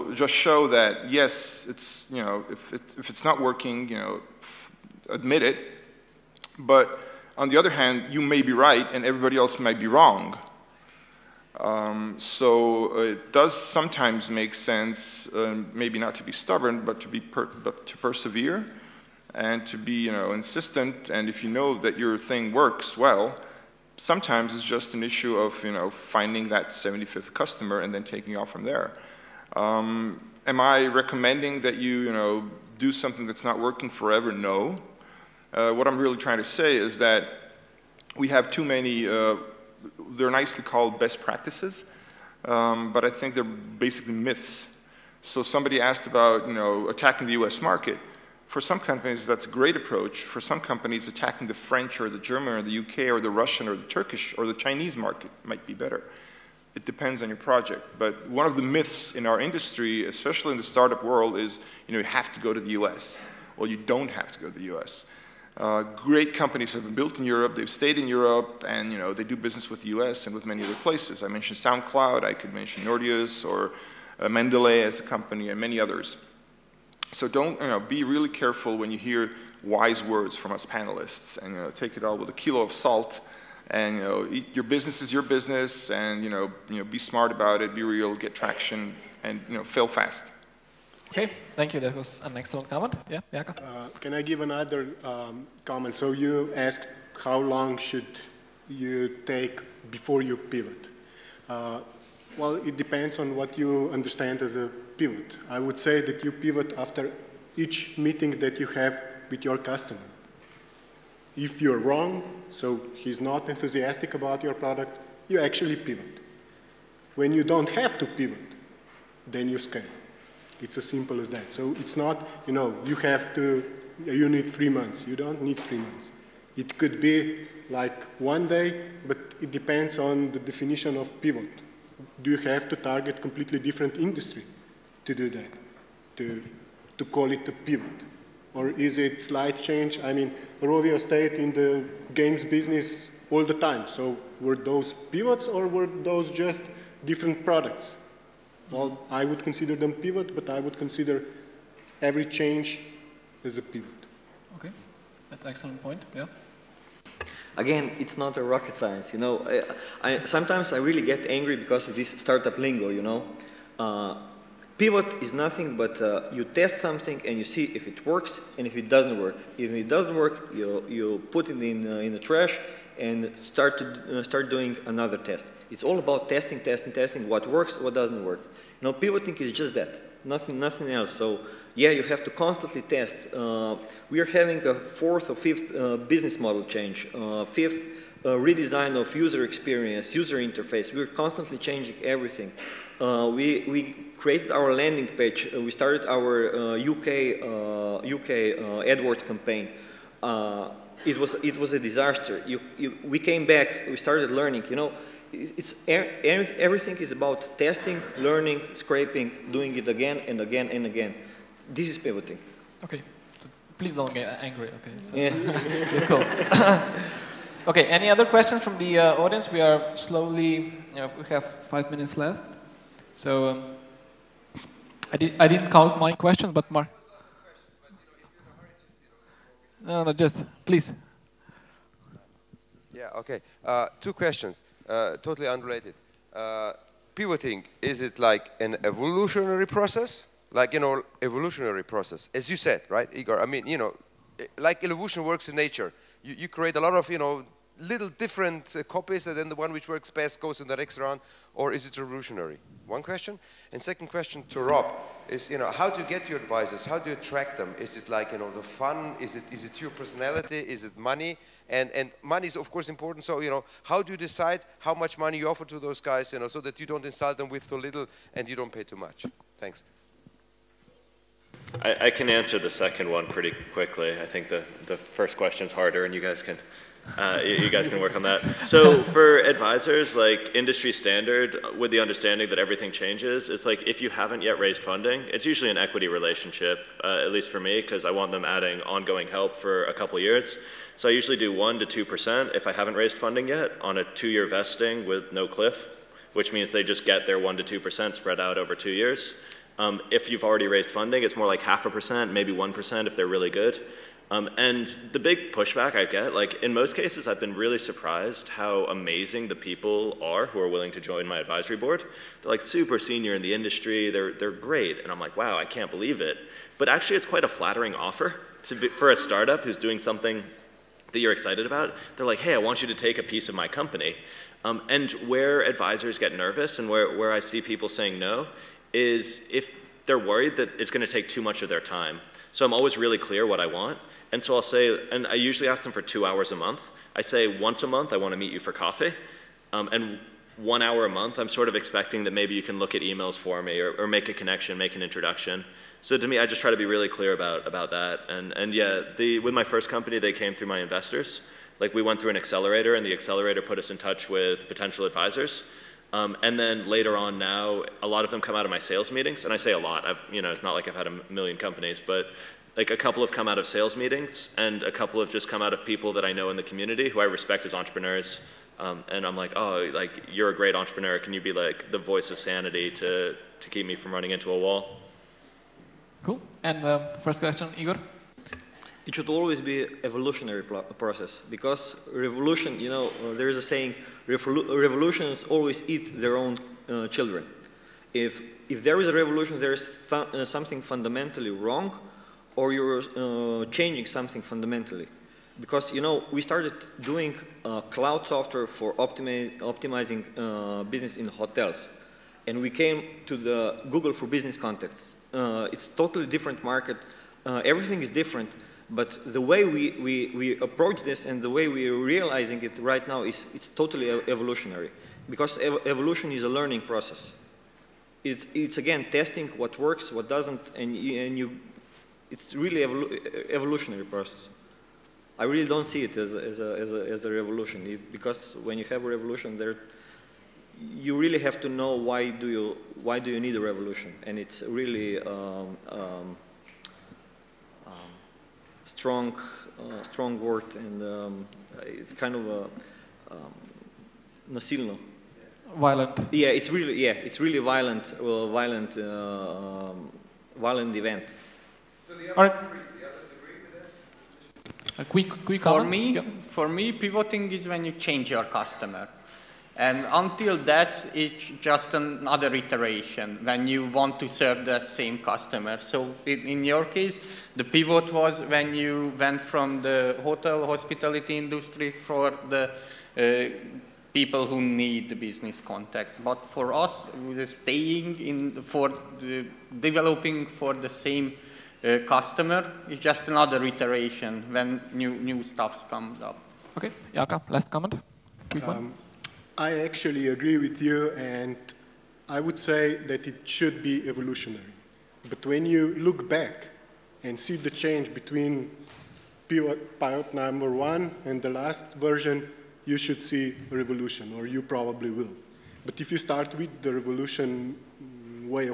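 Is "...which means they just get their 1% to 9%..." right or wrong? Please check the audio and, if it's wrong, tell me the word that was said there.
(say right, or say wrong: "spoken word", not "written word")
wrong: "2", not "9".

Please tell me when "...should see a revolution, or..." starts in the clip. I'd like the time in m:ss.
8:22.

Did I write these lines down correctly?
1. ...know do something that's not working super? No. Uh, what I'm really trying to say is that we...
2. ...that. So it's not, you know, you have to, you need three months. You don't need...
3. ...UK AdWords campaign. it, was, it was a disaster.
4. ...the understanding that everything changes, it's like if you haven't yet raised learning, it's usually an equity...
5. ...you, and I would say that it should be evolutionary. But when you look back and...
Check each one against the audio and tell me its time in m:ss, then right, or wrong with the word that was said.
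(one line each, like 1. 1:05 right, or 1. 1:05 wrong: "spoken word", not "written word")
1. 0:32 wrong: "forever", not "super"
2. 2:01 right
3. 3:18 right
4. 4:41 wrong: "funding", not "learning"
5. 8:10 right.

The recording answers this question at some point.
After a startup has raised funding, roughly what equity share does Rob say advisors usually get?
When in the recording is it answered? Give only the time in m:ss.
5:01.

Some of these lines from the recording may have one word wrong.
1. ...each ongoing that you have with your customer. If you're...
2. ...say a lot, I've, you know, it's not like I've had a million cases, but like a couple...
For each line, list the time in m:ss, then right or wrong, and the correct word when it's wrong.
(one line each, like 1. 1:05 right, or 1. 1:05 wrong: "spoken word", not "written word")
1. 1:47 wrong: "meeting", not "ongoing"
2. 5:59 wrong: "companies", not "cases".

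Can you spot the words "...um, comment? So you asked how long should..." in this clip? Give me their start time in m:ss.
1:35.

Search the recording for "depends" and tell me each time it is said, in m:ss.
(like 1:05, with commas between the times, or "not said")
0:56, 1:42, 2:09.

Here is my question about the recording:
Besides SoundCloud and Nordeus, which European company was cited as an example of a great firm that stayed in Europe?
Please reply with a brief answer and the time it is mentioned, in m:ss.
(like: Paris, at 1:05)
Mendeley, at 1:14.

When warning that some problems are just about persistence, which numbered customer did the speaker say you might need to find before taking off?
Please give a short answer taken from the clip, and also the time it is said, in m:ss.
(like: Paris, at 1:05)
75th, at 0:26.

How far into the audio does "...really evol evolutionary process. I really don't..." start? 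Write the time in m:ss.
7:02.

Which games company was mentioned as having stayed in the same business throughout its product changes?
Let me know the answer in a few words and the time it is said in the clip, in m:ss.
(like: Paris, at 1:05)
Rovio, at 2:20.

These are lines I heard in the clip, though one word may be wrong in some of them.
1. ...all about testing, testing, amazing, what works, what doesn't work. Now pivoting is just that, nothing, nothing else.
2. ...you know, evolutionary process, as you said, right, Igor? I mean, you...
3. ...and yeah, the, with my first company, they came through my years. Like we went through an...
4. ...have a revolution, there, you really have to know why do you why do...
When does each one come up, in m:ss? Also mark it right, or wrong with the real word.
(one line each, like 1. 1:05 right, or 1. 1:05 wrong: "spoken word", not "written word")
1. 2:55 wrong: "testing", not "amazing"
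2. 4:00 right
3. 5:48 wrong: "investors", not "years"
4. 7:08 right.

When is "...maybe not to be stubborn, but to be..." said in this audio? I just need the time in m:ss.
0:15.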